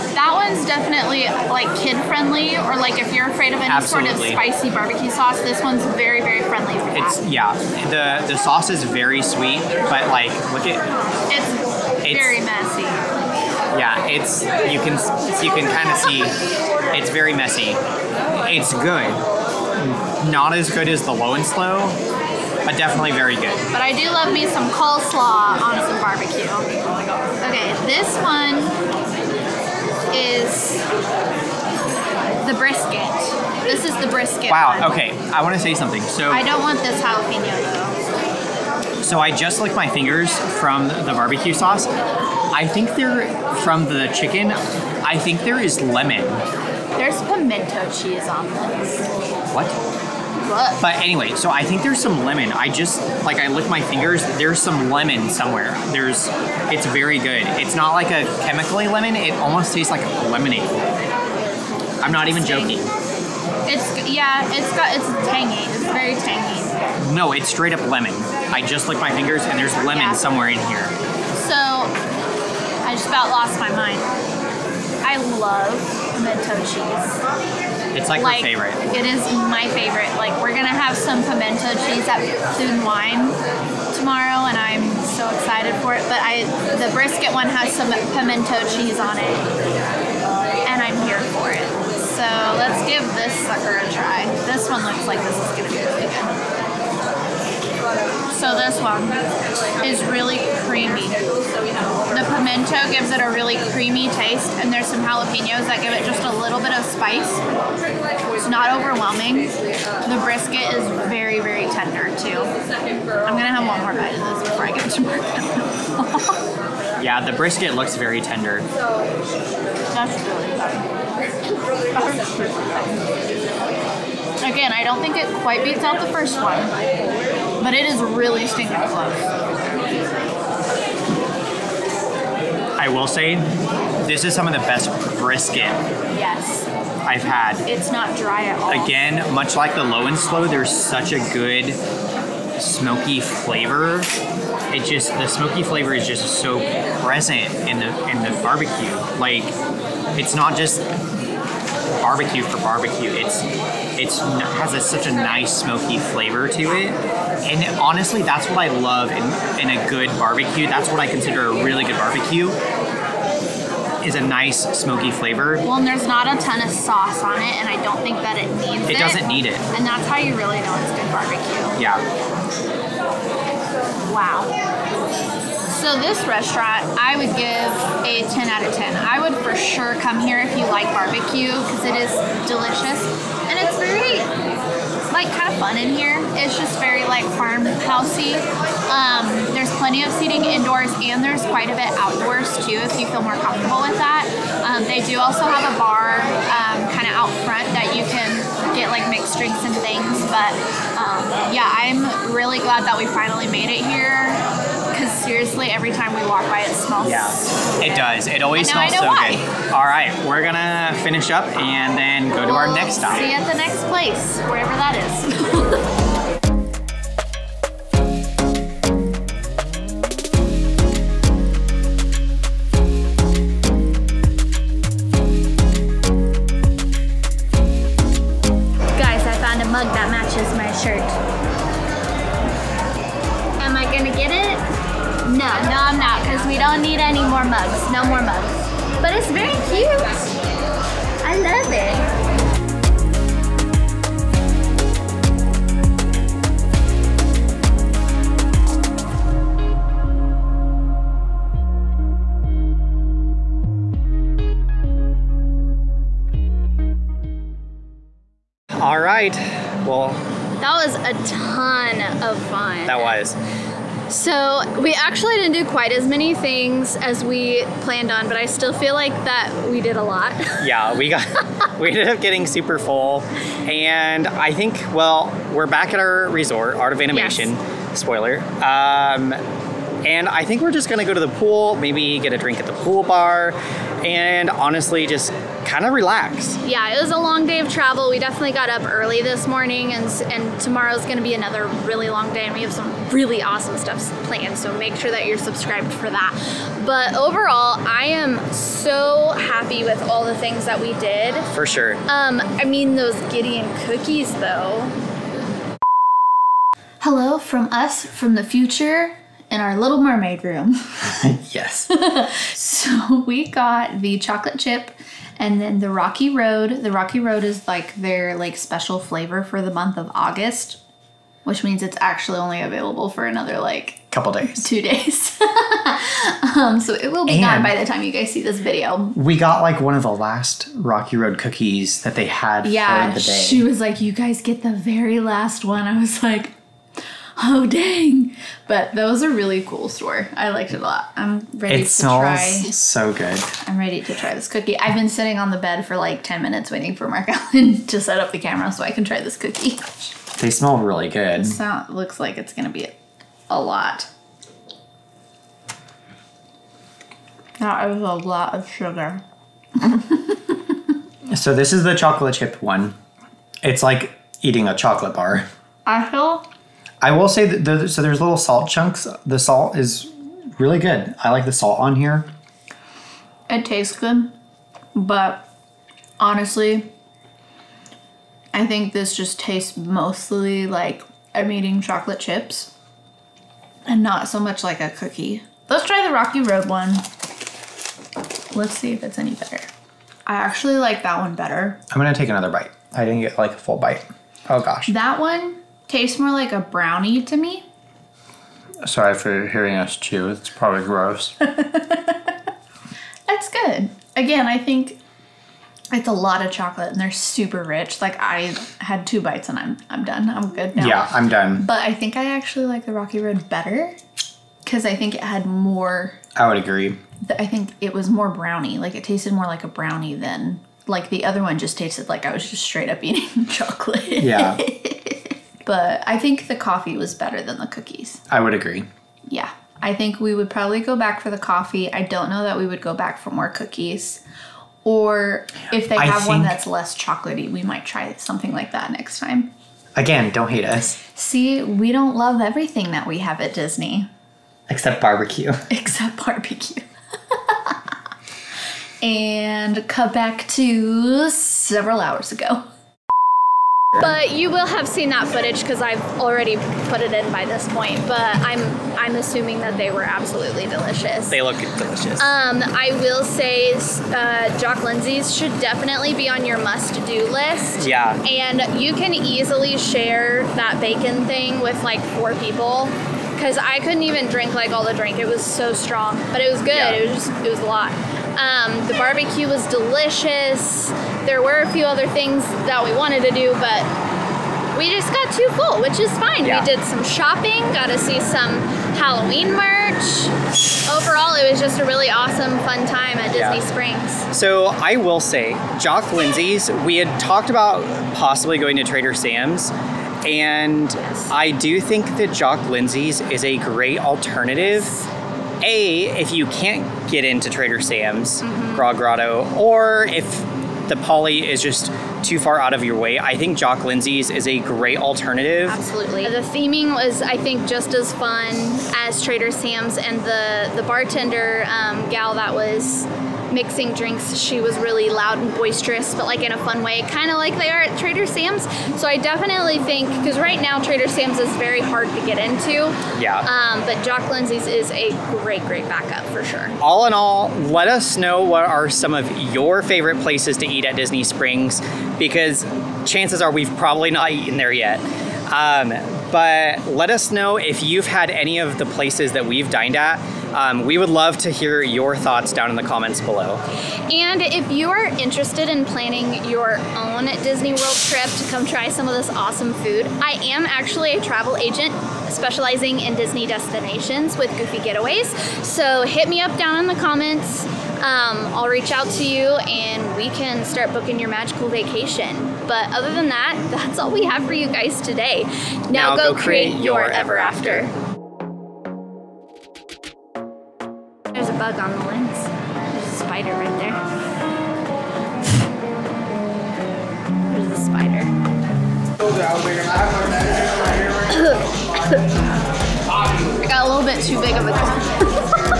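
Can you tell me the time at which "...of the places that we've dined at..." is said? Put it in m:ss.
9:08.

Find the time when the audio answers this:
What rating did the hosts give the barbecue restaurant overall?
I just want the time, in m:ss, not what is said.
2:58.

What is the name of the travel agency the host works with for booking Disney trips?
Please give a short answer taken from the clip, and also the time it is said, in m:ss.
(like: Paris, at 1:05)
Goofy Getaways, at 9:24.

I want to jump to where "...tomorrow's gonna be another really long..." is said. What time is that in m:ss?
4:50.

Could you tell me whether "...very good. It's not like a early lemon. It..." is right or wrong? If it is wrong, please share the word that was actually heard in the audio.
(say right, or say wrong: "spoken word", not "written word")
wrong: "chemically", not "early".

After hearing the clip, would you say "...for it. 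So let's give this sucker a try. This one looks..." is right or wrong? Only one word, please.
right.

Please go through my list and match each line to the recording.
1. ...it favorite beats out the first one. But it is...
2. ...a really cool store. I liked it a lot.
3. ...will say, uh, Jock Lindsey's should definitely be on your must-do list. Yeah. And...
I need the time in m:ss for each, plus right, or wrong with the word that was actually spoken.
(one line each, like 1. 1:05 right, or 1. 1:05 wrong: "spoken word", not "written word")
1. 2:05 wrong: "quite", not "favorite"
2. 5:39 right
3. 7:43 right.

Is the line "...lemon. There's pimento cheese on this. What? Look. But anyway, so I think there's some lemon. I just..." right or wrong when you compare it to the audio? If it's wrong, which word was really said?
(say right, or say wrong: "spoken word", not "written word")
right.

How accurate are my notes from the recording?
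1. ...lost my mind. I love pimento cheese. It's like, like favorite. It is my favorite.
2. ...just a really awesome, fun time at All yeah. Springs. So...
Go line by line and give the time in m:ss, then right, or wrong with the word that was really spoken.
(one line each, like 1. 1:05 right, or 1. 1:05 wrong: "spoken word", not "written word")
1. 1:13 right
2. 8:11 wrong: "Disney", not "All".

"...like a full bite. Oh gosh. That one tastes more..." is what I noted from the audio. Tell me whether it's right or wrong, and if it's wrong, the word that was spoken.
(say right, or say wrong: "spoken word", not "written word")
right.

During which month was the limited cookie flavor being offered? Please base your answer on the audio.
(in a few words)
August.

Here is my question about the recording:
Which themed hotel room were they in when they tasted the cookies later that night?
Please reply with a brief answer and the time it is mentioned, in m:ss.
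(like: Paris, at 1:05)
Little Mermaid, at 5:09.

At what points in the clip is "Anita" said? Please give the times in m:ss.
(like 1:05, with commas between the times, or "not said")
not said.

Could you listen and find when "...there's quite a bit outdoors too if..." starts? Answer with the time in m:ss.
3:11.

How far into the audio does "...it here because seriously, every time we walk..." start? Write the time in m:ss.
3:23.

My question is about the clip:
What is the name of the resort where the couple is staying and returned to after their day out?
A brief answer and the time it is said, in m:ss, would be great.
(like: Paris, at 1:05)
Art of Animation, at 4:36.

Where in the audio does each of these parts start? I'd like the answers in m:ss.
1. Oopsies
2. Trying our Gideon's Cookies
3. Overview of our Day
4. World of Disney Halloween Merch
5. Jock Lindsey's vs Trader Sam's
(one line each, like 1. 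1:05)
1. 9:37
2. 5:05
3. 4:18
4. 3:35
5. 7:32.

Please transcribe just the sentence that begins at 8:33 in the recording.
I think Jock Lindsey's is a great alternative.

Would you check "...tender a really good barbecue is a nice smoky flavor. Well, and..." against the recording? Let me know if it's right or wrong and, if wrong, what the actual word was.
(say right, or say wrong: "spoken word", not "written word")
wrong: "consider", not "tender".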